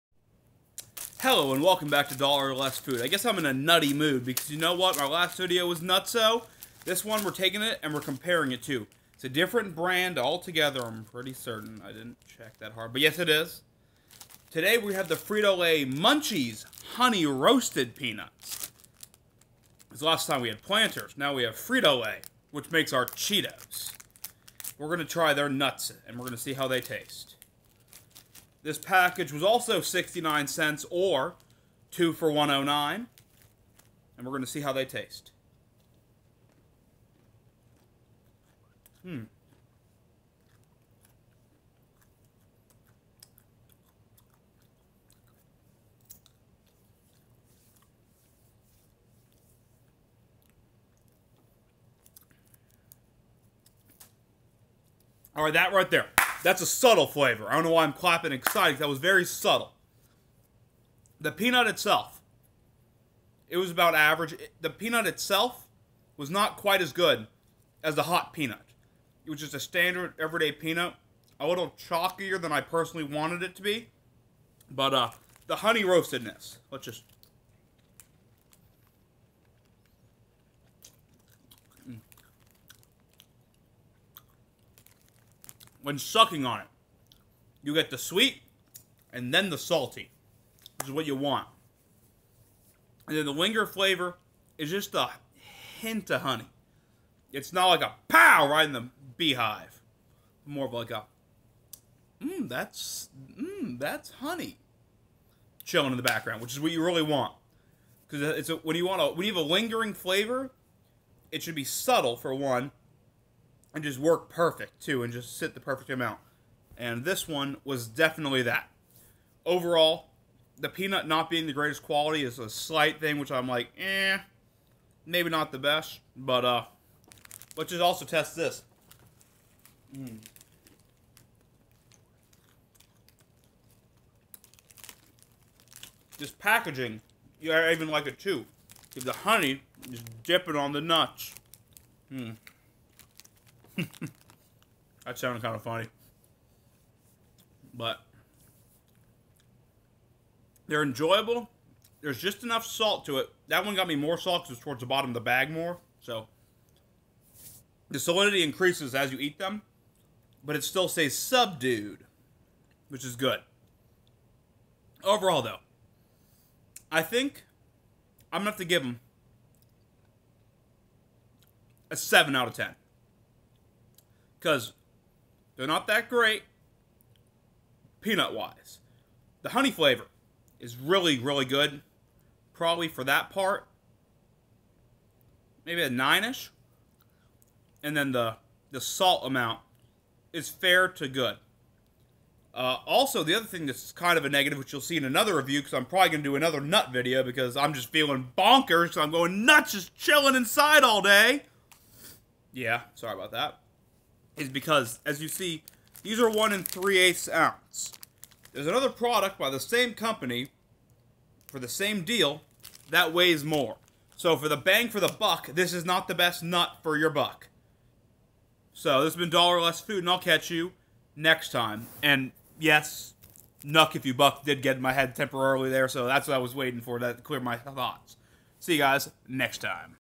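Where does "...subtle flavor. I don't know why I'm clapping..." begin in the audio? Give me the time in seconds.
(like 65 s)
56 s.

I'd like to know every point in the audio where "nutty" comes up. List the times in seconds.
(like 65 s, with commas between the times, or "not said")
3 s.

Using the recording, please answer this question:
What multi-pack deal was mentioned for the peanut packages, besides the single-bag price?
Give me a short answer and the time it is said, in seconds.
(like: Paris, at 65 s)
2 for $1.09, at 31 s.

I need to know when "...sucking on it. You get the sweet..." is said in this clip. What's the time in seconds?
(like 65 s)
85 s.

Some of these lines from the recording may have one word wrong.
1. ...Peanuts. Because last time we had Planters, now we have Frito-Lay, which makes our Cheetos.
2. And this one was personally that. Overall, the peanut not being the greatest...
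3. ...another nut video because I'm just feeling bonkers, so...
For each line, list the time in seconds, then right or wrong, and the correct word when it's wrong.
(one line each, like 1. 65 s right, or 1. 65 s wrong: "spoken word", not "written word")
1. 17 s right
2. 116 s wrong: "definitely", not "personally"
3. 196 s right.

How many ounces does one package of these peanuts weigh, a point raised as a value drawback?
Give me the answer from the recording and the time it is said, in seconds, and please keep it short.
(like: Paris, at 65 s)
1 3/8 ounce, at 206 s.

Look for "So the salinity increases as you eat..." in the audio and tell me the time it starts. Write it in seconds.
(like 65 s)
156 s.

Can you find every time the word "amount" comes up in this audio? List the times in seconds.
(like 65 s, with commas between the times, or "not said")
115 s, 189 s.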